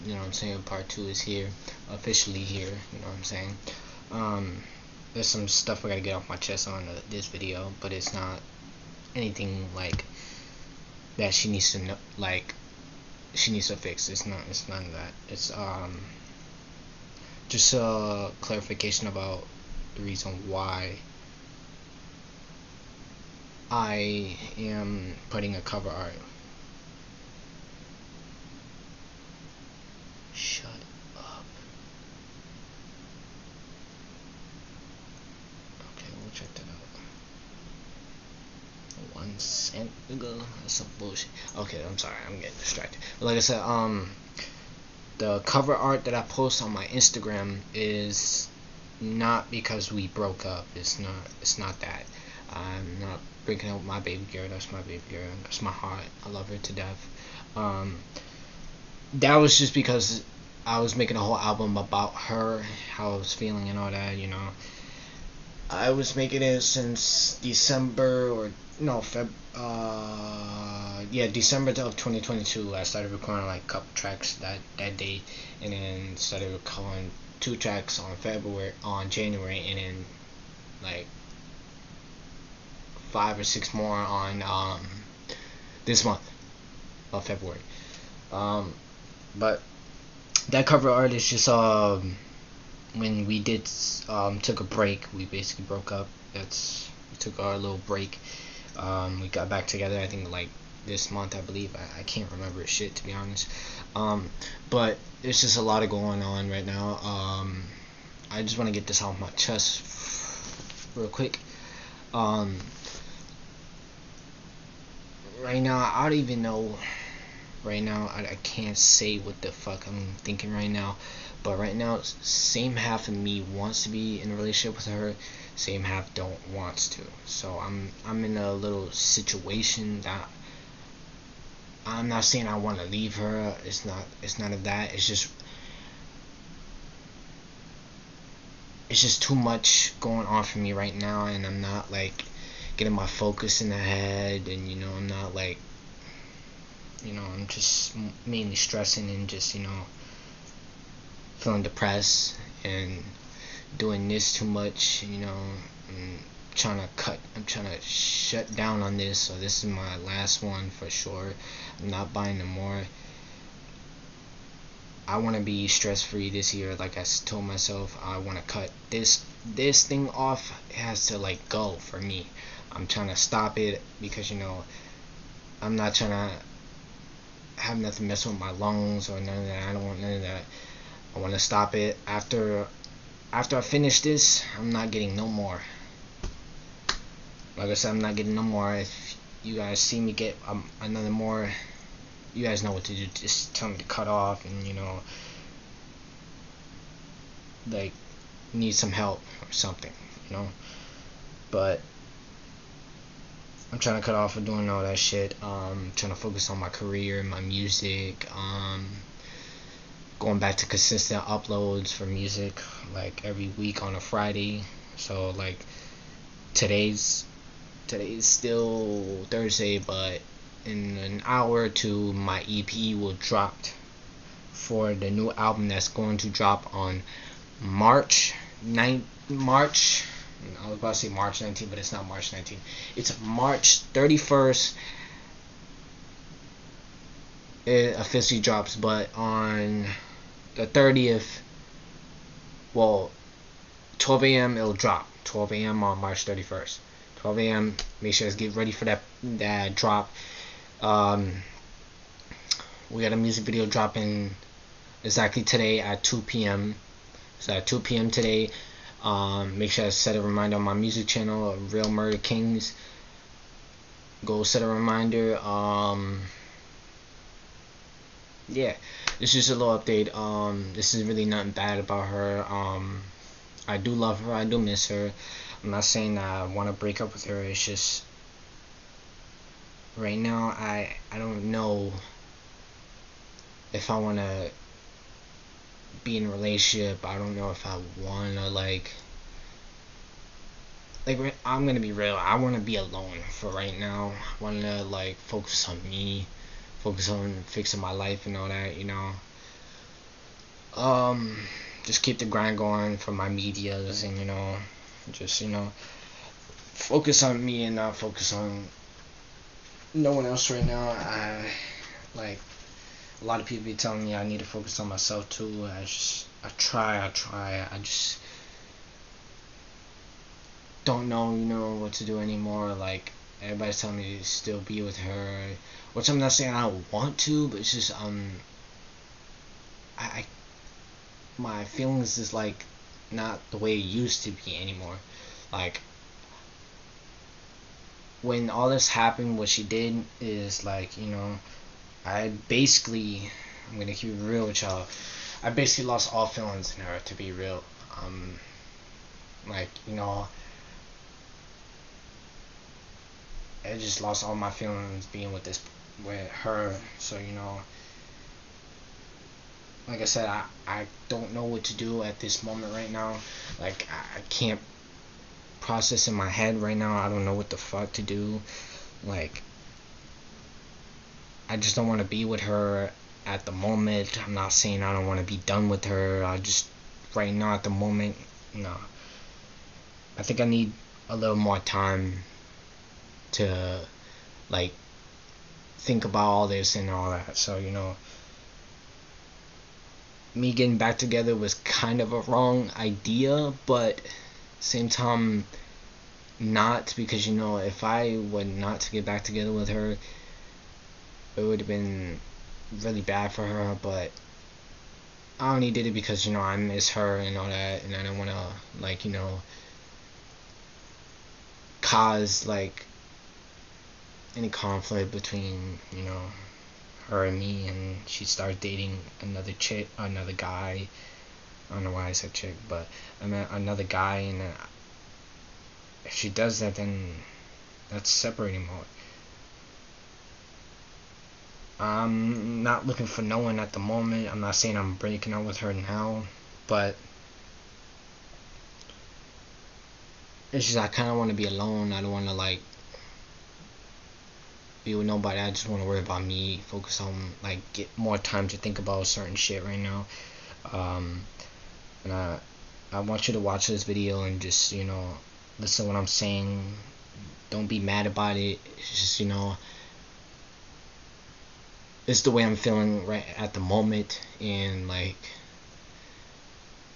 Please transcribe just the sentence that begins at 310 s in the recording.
I, like, a lot of people be telling me I need to focus on myself too.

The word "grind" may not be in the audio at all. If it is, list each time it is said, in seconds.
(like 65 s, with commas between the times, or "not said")
302 s.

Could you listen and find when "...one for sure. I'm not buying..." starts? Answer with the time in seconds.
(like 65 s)
160 s.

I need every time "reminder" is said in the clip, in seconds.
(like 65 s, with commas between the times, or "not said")
260 s, 264 s.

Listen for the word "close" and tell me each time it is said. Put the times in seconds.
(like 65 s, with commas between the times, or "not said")
not said.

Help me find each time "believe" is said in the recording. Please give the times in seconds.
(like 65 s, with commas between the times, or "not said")
101 s.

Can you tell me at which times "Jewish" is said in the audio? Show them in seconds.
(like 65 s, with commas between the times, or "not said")
not said.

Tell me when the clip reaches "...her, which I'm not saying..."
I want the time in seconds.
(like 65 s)
324 s.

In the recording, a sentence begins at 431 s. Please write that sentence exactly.
I'm not looking for no one at the moment.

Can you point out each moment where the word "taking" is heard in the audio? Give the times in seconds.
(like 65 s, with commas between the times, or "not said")
not said.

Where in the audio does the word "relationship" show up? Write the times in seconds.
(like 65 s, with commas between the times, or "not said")
124 s, 286 s.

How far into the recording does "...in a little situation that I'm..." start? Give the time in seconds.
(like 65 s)
128 s.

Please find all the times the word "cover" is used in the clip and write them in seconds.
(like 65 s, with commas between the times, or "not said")
25 s, 45 s, 90 s.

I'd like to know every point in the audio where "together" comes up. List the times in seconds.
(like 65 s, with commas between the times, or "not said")
99 s, 390 s, 399 s.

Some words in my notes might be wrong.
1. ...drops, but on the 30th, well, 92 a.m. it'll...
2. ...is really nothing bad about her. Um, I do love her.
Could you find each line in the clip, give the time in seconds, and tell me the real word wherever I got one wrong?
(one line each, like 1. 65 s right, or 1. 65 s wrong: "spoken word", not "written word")
1. 238 s wrong: "12", not "92"
2. 270 s right.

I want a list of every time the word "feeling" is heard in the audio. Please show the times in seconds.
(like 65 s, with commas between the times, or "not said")
63 s, 151 s, 331 s, 346 s, 354 s, 462 s.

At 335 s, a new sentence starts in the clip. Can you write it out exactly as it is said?
Like when all this happened, what she did is like you know, I basically I'm gonna keep it real with y'all.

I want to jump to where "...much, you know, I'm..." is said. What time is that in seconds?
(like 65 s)
154 s.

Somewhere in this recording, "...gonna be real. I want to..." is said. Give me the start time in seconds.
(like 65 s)
291 s.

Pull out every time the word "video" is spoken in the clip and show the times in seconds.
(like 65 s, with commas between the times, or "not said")
7 s, 253 s, 453 s.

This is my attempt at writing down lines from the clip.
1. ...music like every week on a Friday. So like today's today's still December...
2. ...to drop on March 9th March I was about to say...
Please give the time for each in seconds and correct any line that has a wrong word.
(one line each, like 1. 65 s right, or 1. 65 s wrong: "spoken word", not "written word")
1. 212 s wrong: "Thursday", not "December"
2. 226 s right.